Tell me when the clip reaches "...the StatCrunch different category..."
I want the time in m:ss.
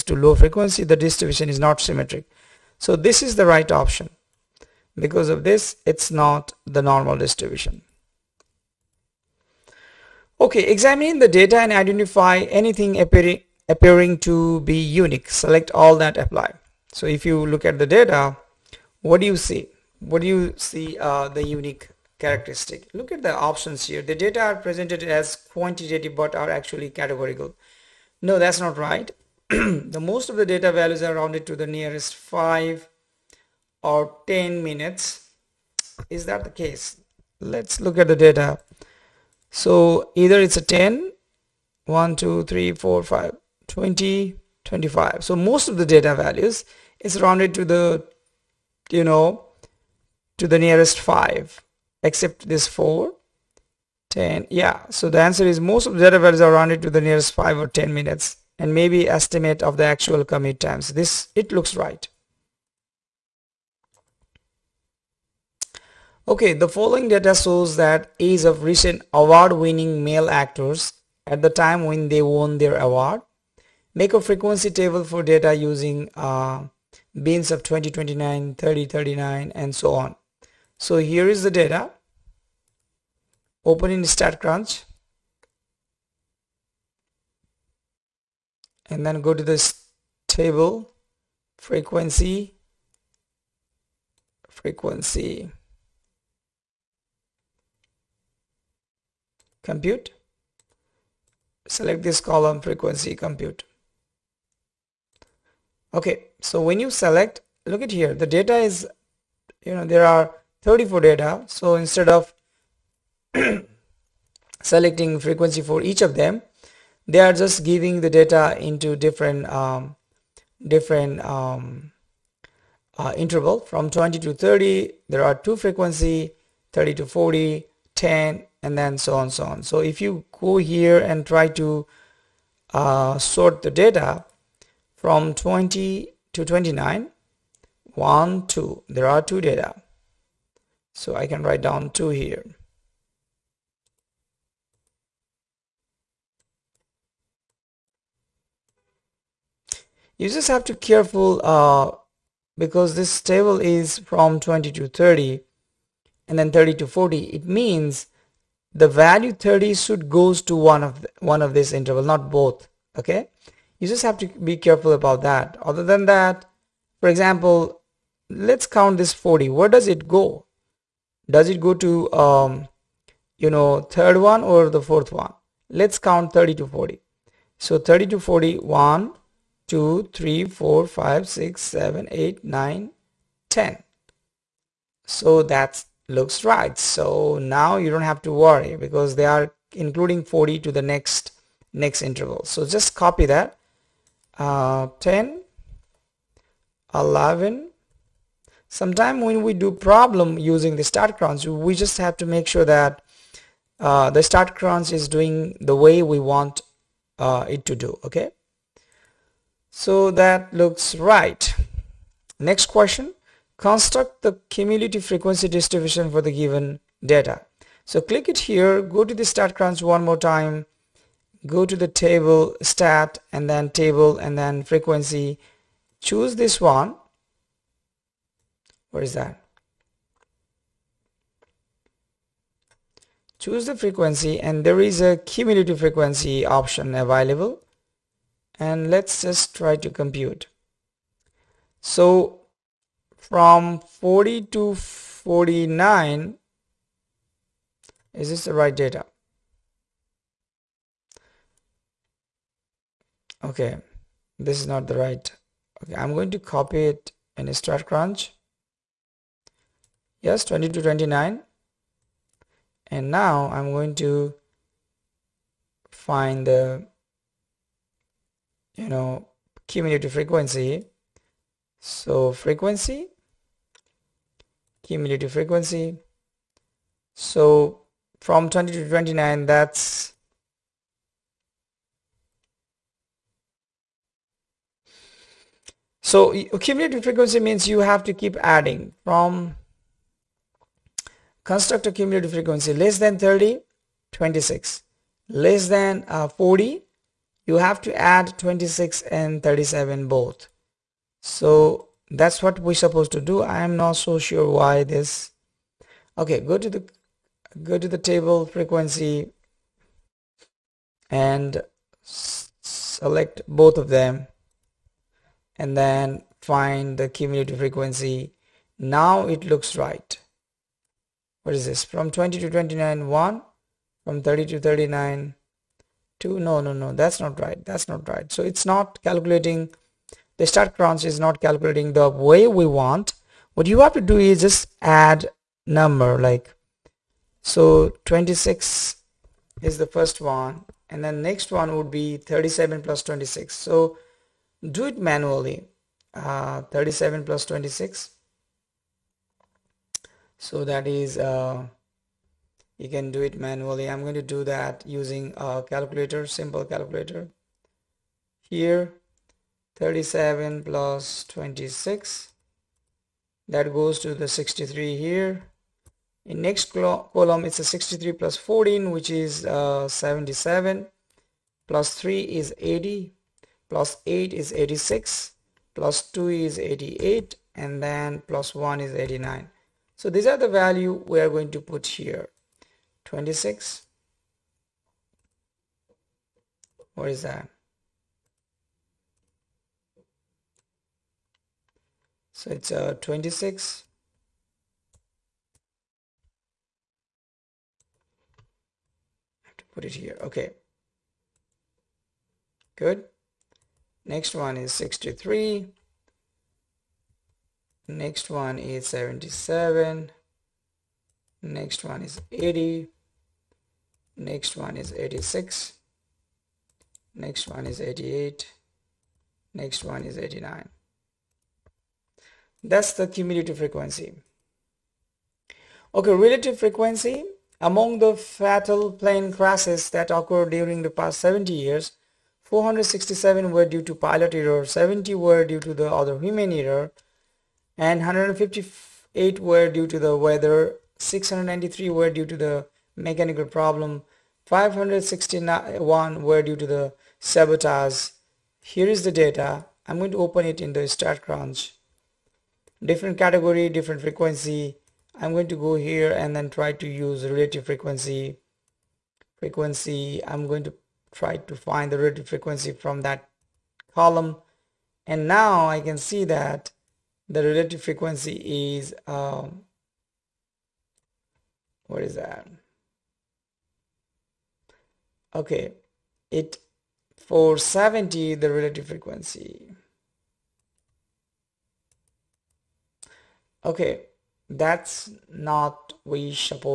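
7:30.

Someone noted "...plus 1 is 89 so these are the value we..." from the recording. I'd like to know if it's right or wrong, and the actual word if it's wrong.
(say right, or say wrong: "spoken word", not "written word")
right.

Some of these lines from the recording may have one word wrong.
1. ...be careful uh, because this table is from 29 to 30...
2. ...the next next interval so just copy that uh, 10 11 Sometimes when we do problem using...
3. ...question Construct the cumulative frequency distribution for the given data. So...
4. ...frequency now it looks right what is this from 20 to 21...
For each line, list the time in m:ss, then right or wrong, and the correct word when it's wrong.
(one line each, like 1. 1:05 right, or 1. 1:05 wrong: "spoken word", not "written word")
1. 2:30 wrong: "20", not "29"
2. 3:10 right
3. 3:32 right
4. 5:17 wrong: "29", not "21".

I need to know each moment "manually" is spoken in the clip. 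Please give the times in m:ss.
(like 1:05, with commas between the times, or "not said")
5:44, 5:53.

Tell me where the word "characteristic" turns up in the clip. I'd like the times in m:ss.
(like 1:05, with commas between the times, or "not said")
0:22.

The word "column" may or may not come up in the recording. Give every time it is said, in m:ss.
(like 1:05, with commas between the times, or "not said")
1:42, 6:06, 7:43.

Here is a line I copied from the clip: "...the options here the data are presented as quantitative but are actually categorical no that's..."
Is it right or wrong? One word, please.
right.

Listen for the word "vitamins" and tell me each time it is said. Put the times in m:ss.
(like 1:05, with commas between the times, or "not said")
not said.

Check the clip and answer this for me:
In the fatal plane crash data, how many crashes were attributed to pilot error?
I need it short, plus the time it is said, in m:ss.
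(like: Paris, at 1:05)
467, at 7:12.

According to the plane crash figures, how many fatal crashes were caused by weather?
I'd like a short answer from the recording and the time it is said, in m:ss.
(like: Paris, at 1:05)
158, at 7:17.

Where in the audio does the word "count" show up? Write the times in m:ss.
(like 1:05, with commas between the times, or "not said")
2:48, 2:55.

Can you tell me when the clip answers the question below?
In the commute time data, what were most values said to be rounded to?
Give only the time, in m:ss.
0:32.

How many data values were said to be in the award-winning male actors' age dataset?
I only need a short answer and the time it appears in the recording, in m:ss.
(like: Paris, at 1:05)
34, at 1:50.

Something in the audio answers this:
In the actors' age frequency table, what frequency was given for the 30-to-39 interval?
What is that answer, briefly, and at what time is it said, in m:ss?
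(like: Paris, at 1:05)
10, at 2:06.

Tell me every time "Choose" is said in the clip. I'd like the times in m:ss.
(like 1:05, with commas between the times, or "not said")
3:46, 3:53.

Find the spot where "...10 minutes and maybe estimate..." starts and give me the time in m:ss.
0:57.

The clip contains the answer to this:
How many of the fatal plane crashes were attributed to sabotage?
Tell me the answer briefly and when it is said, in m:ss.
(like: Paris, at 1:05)
561, at 7:24.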